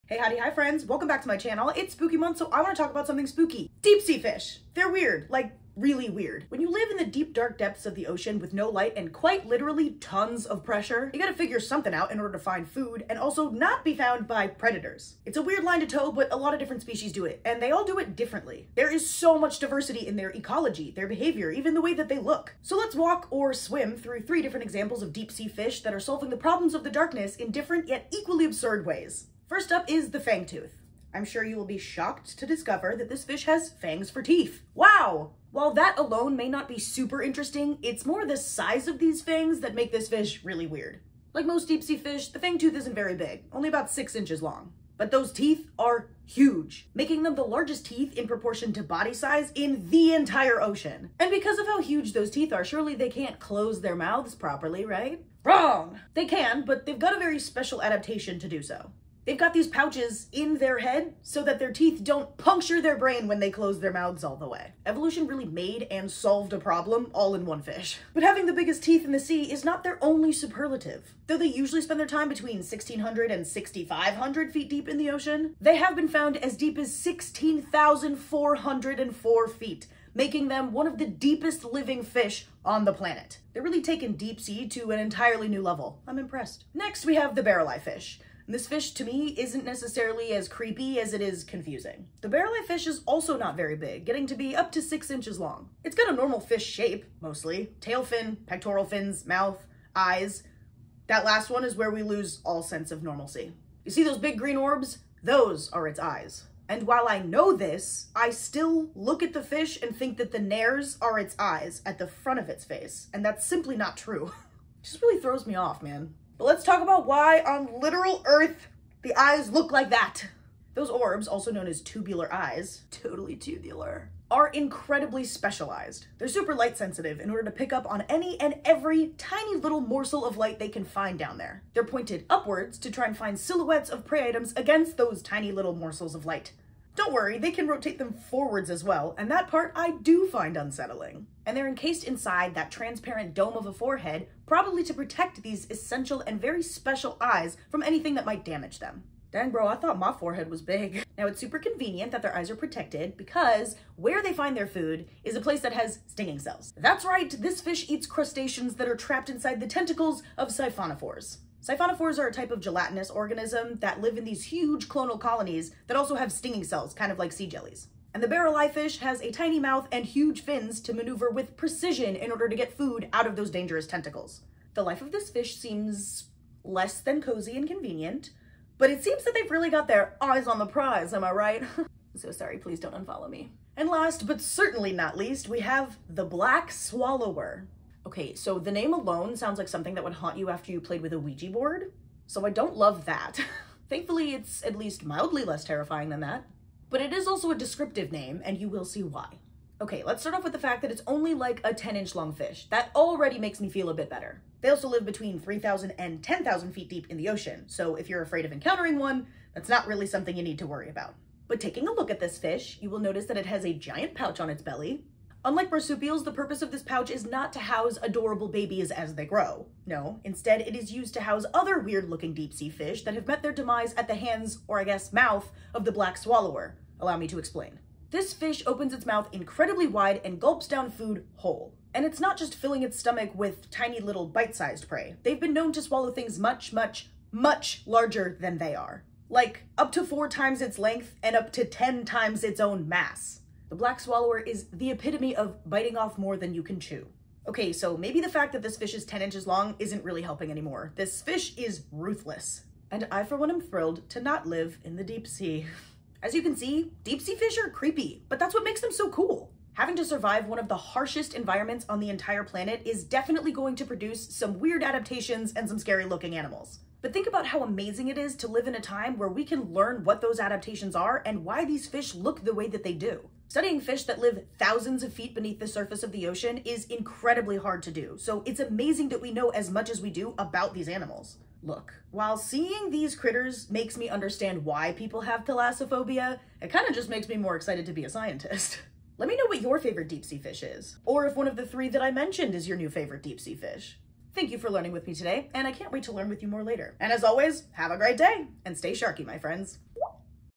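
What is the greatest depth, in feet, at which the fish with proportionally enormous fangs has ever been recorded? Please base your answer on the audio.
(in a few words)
16,404 feet.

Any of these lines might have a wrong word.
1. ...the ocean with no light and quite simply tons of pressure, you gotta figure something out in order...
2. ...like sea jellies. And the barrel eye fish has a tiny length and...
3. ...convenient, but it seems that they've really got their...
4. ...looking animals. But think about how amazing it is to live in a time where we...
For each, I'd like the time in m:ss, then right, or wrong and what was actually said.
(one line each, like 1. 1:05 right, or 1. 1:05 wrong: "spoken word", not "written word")
1. 0:07 wrong: "literally", not "simply"
2. 2:47 wrong: "mouth", not "length"
3. 2:57 right
4. 4:26 right.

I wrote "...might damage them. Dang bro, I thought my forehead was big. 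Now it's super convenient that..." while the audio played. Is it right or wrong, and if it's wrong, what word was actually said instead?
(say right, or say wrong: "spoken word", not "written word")
right.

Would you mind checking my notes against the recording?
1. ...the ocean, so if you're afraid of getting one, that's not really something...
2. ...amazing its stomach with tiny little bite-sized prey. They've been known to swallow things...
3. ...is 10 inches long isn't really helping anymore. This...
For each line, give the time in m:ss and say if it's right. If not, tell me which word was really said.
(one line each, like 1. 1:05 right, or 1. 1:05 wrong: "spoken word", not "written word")
1. 3:27 wrong: "encountering", not "getting"
2. 3:52 wrong: "filling", not "amazing"
3. 4:08 right.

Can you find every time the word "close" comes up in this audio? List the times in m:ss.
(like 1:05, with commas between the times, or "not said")
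0:53, 1:03.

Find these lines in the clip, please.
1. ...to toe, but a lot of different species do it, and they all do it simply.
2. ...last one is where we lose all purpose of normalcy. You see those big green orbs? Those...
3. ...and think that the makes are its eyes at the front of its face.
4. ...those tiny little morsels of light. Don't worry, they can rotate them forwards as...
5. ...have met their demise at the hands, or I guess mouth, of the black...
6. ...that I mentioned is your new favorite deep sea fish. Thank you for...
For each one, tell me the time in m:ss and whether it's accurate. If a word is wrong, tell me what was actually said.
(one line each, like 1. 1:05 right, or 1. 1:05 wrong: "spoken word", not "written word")
1. 0:15 wrong: "differently", not "simply"
2. 1:41 wrong: "sense", not "purpose"
3. 1:49 wrong: "nares", not "makes"
4. 2:14 right
5. 3:43 right
6. 4:51 right.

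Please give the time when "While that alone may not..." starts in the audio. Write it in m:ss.
0:35.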